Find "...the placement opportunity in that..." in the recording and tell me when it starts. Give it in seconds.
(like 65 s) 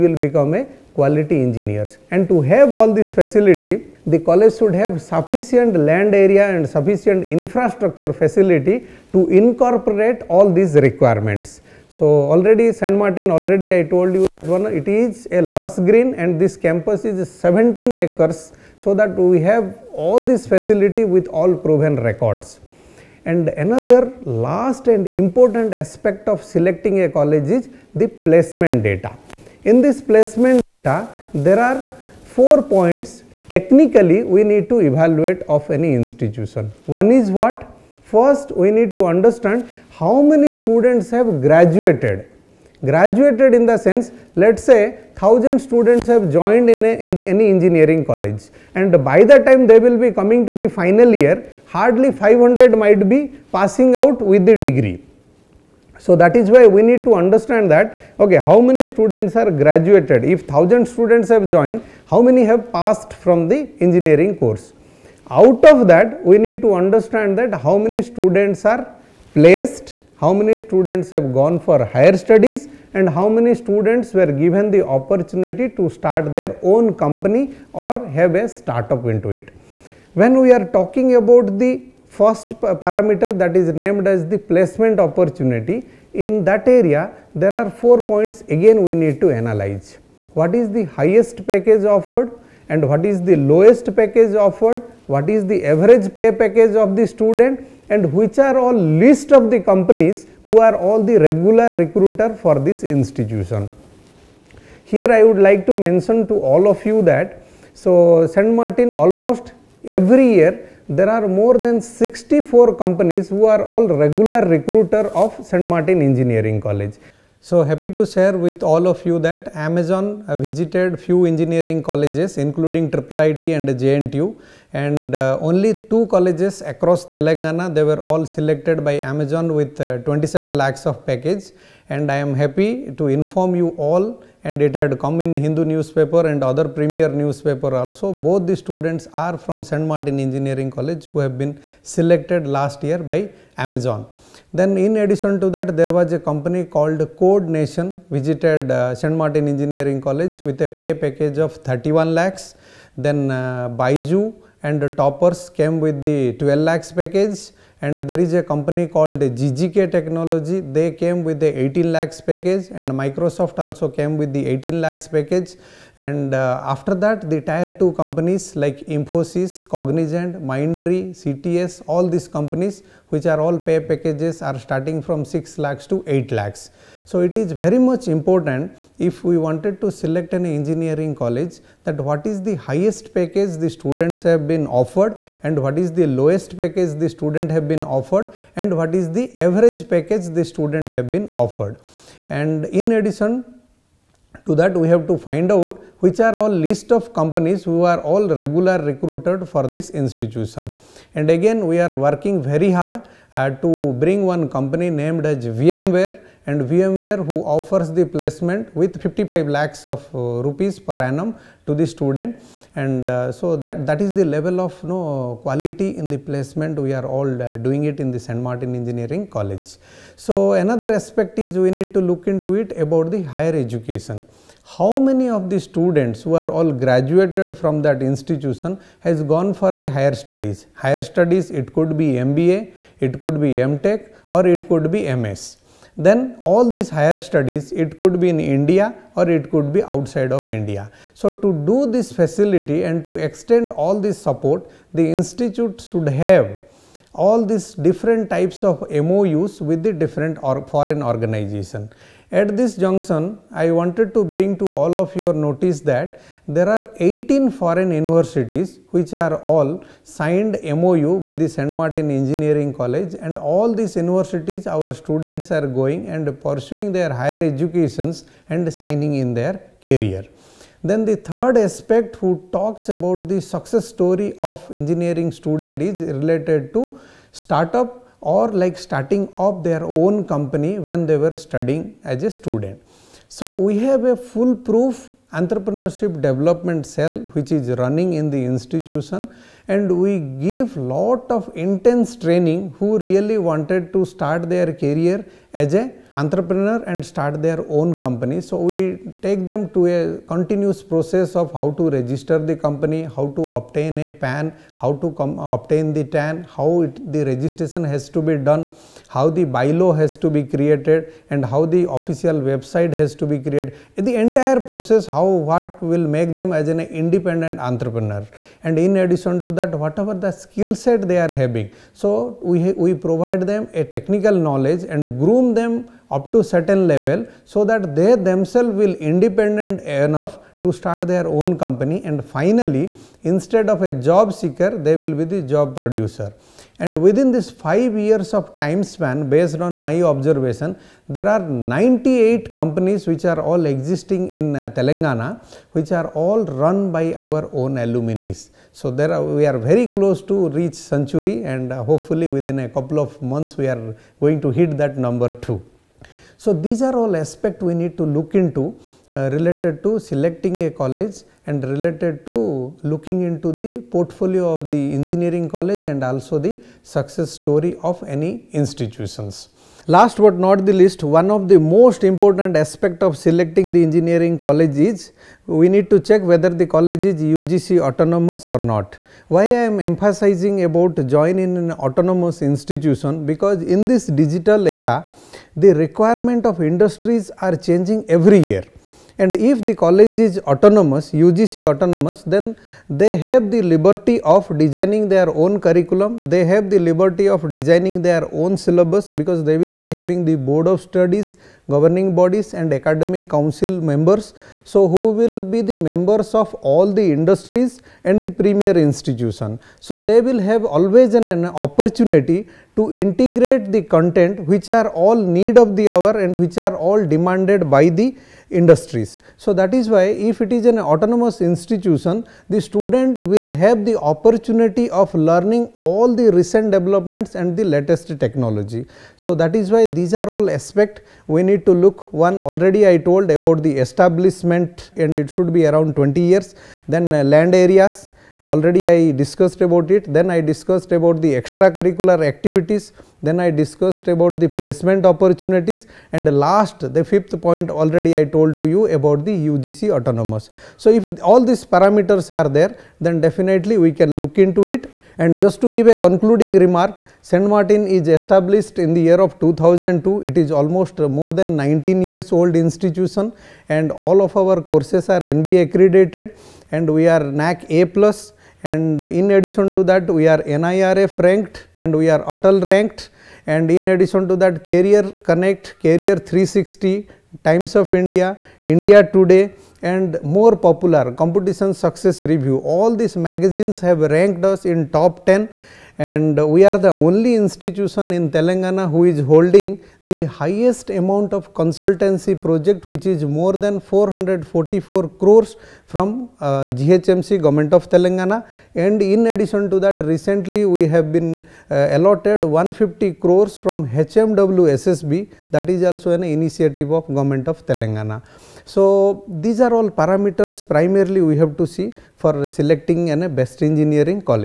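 84 s.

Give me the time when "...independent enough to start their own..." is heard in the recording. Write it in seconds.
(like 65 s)
328 s.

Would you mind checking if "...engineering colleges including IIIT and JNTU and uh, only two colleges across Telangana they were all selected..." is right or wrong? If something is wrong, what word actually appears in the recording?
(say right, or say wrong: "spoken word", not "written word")
right.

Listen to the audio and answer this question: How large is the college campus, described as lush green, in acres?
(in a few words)
17 acres.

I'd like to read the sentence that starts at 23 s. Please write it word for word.
And another last and important aspect of selecting a college is the placement data.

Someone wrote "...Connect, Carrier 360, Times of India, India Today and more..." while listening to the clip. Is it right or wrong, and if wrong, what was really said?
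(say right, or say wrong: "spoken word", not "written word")
right.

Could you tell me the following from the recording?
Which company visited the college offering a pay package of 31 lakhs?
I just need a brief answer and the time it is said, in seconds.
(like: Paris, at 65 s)
Code Nation, at 147 s.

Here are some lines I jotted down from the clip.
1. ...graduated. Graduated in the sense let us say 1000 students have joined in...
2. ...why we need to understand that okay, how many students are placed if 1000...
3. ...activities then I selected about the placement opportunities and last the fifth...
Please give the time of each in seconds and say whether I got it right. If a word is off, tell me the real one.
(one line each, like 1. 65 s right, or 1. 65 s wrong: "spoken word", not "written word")
1. 41 s right
2. 56 s wrong: "graduated", not "placed"
3. 442 s wrong: "discussed", not "selected".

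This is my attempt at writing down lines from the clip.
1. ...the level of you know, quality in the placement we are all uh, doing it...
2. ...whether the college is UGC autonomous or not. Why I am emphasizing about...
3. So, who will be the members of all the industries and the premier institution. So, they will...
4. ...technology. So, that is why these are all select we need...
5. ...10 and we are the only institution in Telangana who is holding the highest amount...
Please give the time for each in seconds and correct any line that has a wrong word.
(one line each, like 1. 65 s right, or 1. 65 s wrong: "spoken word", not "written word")
1. 214 s right
2. 376 s right
3. 404 s right
4. 428 s wrong: "aspect", not "select"
5. 485 s right.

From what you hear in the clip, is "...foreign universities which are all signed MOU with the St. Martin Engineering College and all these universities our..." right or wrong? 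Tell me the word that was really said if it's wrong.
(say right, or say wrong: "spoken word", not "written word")
right.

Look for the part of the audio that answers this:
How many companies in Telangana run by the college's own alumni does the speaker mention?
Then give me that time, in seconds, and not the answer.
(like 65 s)
341 s.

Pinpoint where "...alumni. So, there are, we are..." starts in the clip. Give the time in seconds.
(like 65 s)
347 s.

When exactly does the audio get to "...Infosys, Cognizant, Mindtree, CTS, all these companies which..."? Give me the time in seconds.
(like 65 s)
168 s.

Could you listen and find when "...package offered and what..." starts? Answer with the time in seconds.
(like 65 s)
91 s.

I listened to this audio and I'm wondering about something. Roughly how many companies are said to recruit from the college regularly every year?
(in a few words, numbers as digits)
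more than 64.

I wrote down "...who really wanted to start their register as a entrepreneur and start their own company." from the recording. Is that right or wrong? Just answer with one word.
wrong.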